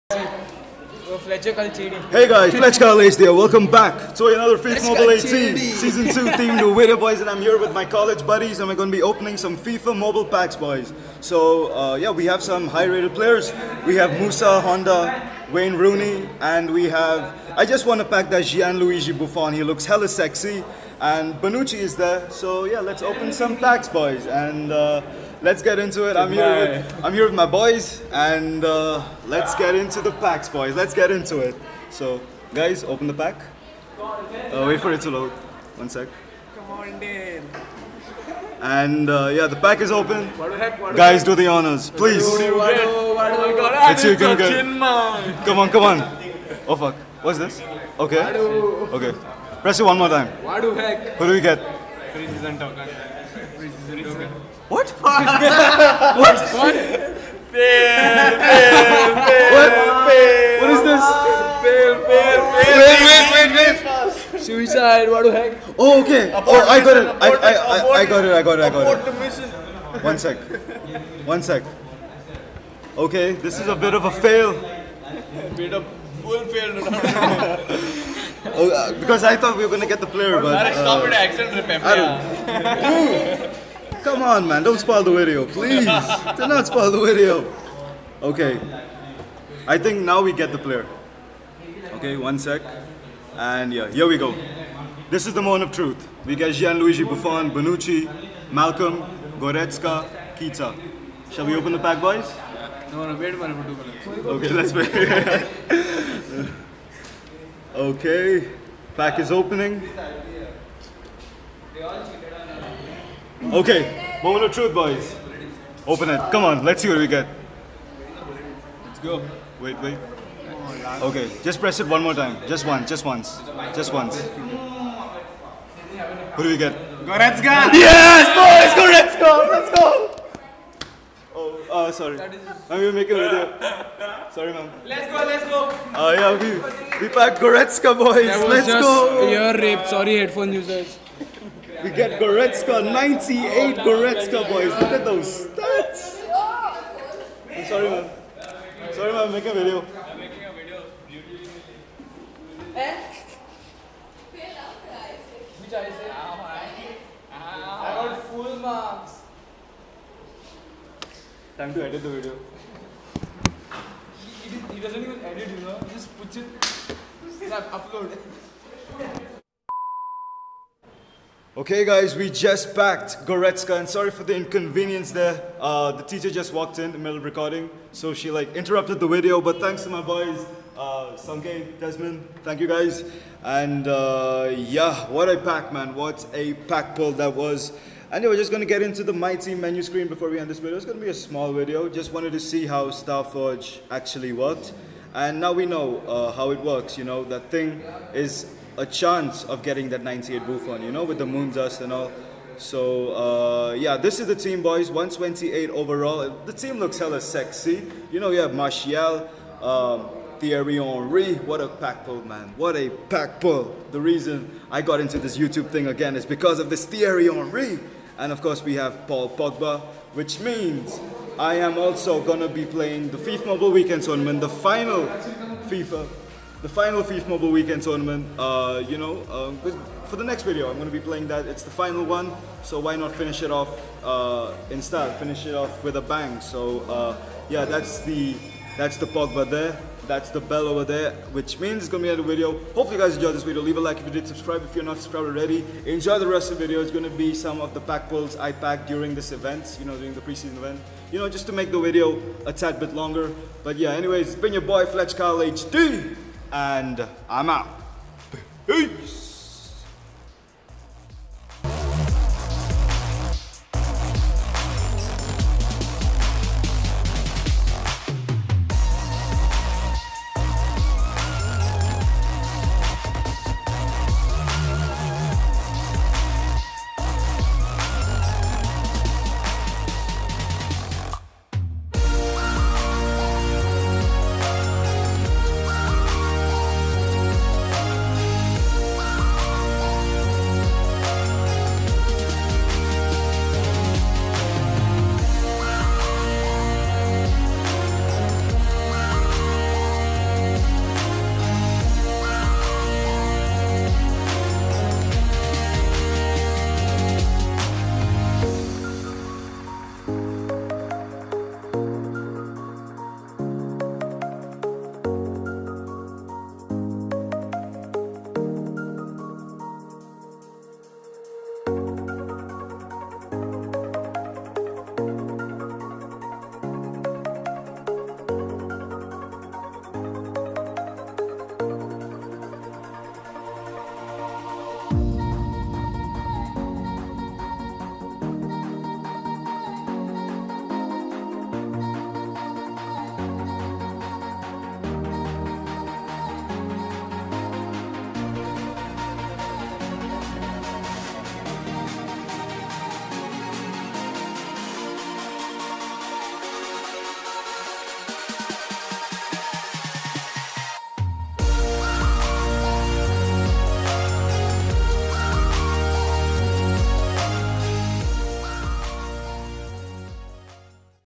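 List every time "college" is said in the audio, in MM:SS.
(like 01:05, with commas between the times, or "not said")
00:02, 00:07.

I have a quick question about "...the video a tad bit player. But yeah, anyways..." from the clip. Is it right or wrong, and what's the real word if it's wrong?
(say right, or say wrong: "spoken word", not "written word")
wrong: "longer", not "player".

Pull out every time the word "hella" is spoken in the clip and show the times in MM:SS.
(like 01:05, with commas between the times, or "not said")
00:19, 03:26.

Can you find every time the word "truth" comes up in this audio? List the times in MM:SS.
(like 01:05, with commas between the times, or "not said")
01:35, 01:54.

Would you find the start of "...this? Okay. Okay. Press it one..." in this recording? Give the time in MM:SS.
00:47.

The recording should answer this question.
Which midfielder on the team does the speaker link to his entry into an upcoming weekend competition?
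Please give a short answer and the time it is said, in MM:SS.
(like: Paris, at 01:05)
Paul Pogba, at 03:39.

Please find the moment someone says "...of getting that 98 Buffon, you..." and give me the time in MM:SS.
03:19.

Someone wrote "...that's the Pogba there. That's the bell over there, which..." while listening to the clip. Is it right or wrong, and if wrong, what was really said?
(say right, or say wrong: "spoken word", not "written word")
right.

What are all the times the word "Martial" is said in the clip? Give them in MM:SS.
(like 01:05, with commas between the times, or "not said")
03:28.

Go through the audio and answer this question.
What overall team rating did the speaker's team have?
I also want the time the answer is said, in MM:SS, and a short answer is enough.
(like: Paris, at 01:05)
128, at 03:24.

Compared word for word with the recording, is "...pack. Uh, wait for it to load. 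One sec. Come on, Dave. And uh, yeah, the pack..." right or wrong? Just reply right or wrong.
right.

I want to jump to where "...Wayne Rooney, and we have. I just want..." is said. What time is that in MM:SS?
00:15.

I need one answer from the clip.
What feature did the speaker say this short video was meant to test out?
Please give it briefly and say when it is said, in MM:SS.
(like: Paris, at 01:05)
Starforge, at 03:12.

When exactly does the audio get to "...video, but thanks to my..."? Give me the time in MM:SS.
02:59.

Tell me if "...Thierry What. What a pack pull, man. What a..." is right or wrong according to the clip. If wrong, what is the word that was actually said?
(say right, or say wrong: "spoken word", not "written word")
wrong: "Henry", not "What".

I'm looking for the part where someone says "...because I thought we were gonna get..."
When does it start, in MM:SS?
01:18.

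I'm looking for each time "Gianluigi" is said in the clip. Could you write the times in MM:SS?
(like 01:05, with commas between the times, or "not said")
00:18, 01:36.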